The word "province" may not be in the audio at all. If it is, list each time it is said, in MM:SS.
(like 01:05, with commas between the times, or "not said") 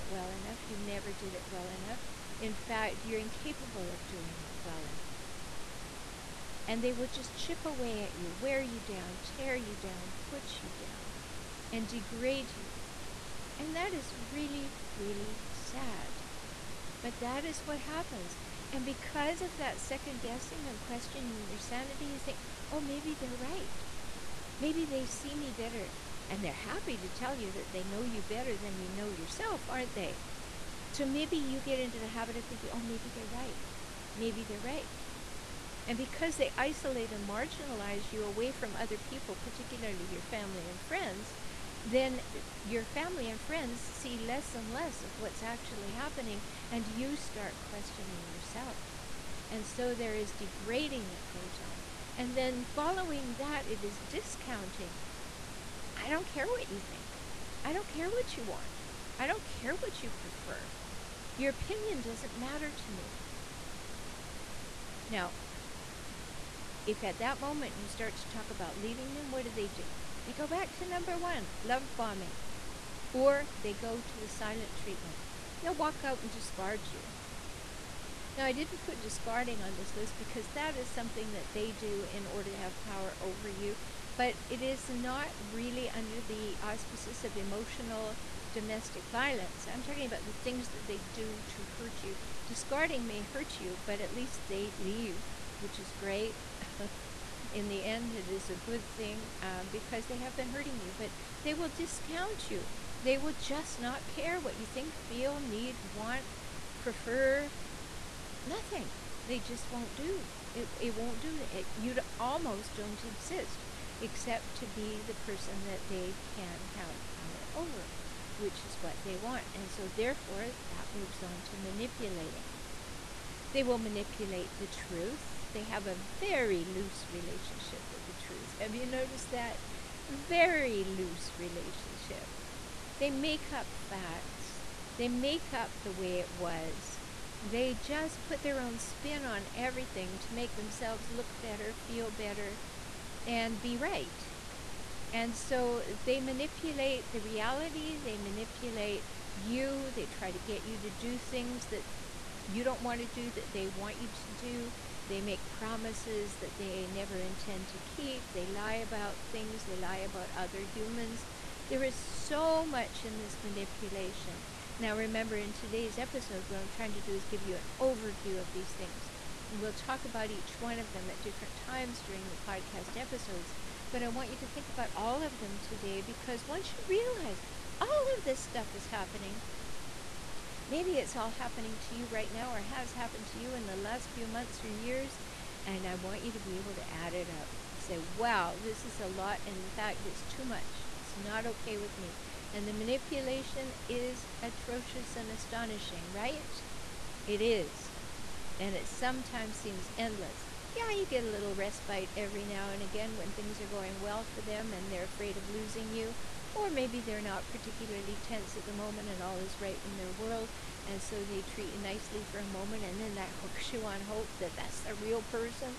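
not said.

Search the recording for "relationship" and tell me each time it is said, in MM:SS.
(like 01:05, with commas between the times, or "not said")
02:07, 02:11.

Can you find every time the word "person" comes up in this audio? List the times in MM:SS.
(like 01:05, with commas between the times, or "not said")
01:55, 03:35.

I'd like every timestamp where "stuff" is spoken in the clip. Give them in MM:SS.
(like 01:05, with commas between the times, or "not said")
02:58.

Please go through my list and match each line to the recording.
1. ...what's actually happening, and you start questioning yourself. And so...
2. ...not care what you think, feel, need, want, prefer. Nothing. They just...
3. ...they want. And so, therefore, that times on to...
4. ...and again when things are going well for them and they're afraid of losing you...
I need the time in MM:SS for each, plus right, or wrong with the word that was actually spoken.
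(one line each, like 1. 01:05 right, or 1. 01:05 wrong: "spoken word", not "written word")
1. 00:45 right
2. 01:43 right
3. 01:59 wrong: "moves", not "times"
4. 03:22 right.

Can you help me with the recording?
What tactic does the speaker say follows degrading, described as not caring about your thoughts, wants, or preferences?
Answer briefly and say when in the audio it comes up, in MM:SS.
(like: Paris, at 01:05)
Discounting, at 00:53.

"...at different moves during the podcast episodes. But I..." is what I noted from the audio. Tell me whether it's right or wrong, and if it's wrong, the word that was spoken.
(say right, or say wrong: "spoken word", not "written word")
wrong: "times", not "moves".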